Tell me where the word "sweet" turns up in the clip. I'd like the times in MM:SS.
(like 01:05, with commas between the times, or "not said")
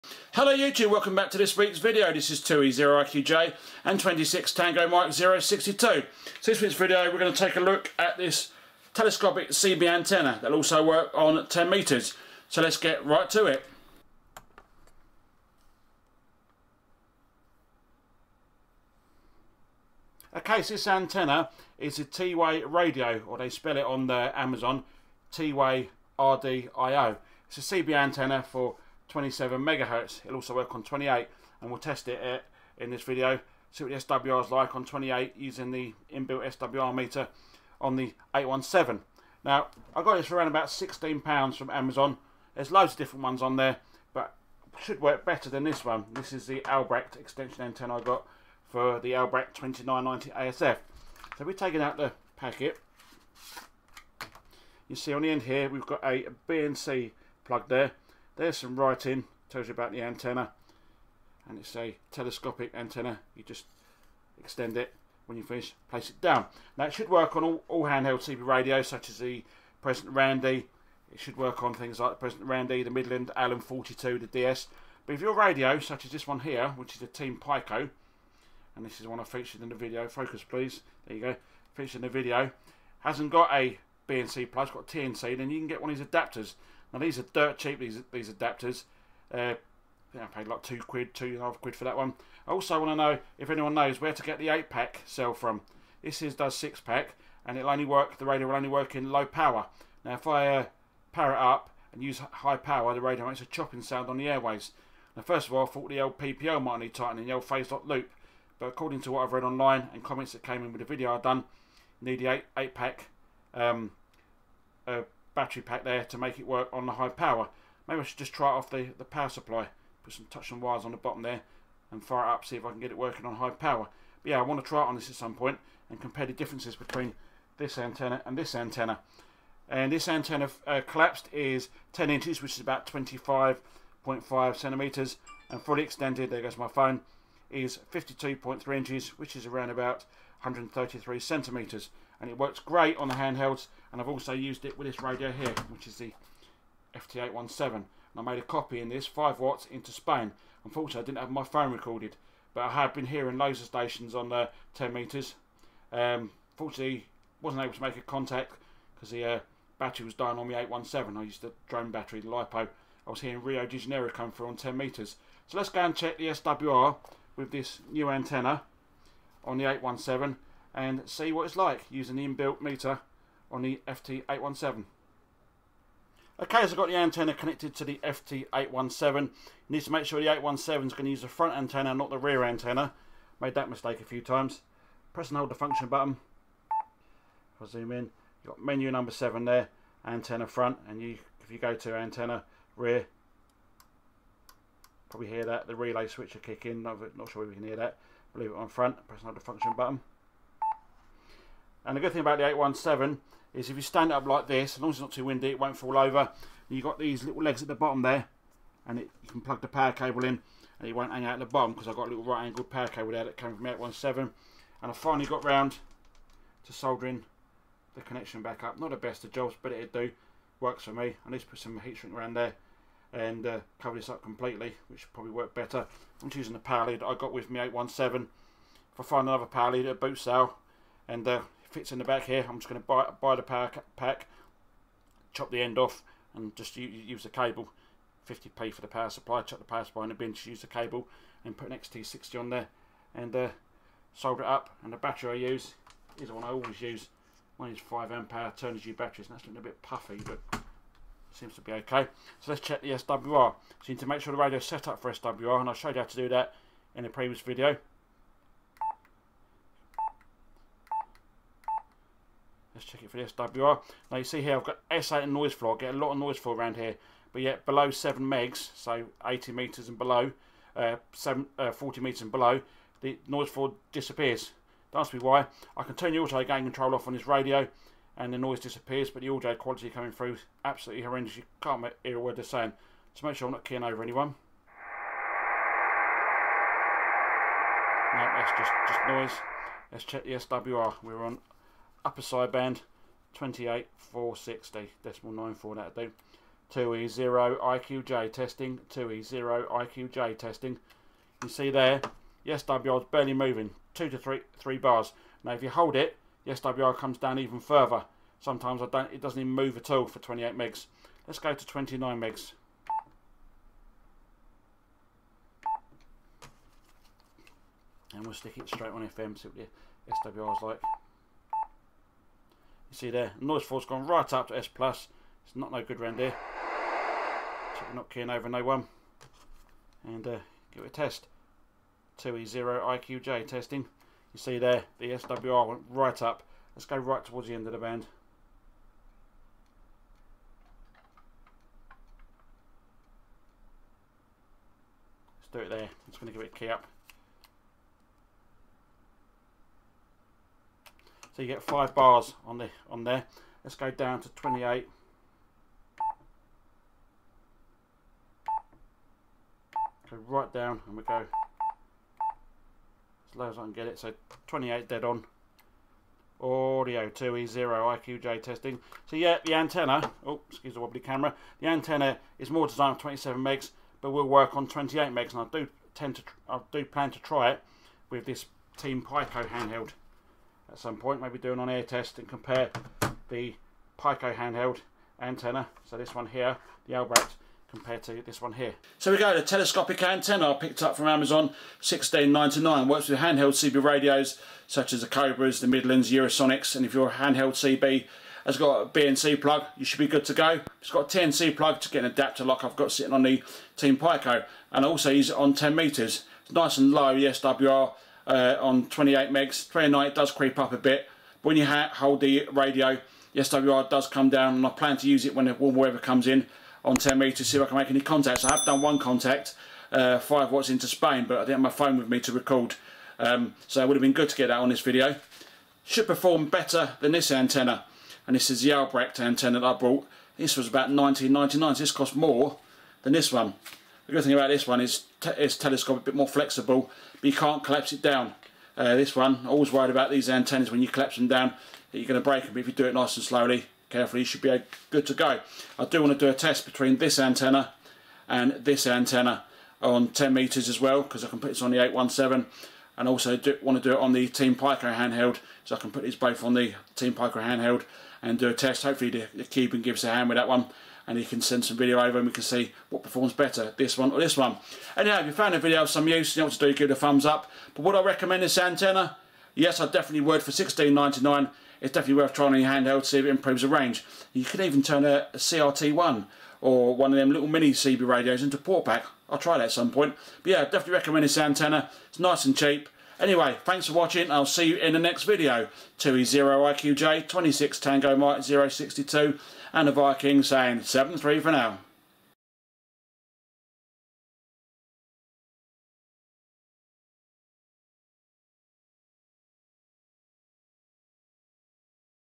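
not said.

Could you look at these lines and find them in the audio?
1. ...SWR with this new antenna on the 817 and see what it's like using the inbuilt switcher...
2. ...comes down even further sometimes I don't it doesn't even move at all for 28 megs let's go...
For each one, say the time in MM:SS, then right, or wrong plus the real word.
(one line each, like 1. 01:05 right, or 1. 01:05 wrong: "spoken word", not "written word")
1. 02:46 wrong: "meter", not "switcher"
2. 05:06 right.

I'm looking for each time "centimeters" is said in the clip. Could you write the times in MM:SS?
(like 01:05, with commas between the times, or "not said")
02:14, 02:21.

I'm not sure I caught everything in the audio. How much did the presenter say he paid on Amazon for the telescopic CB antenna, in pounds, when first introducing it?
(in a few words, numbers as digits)
£16.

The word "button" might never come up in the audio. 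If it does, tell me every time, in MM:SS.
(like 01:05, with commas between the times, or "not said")
03:05, 03:19.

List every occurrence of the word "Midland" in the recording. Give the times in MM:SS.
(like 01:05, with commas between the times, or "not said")
01:12, 06:35.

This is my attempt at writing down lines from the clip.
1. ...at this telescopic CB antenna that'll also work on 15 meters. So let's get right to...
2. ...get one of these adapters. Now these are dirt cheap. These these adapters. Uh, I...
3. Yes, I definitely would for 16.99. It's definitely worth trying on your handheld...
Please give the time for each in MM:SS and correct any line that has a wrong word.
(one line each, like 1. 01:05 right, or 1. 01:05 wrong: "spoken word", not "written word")
1. 00:07 wrong: "10", not "15"
2. 01:25 right
3. 07:49 right.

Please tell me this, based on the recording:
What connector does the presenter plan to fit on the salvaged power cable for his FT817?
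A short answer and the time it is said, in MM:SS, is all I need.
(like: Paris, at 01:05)
XT60, at 04:01.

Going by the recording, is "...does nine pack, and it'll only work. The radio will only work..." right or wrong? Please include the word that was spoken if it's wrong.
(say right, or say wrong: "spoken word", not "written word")
wrong: "six", not "nine".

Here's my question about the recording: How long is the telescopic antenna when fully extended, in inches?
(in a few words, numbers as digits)
52.3 inches.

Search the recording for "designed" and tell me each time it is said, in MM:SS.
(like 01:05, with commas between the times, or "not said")
06:12.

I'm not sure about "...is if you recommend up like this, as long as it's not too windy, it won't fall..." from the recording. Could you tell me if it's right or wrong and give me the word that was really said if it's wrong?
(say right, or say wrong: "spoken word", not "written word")
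wrong: "stand", not "recommend".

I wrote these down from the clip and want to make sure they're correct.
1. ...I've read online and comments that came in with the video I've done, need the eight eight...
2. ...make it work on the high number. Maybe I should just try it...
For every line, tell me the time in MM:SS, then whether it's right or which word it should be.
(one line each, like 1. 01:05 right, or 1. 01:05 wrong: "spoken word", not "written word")
1. 01:49 right
2. 01:56 wrong: "power", not "number".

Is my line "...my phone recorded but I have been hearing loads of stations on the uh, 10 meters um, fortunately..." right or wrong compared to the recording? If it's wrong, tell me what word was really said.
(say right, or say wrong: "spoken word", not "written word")
right.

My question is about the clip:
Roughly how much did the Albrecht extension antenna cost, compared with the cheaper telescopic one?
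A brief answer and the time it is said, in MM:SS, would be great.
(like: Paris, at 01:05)
19.99, at 07:10.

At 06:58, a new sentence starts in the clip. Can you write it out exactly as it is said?
I have done one contact, uh, 5 watts into Spain, but I didn't have my phone with me to record.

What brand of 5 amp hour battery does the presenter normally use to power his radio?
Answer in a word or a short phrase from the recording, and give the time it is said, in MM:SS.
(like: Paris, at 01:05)
Turnigy, at 04:08.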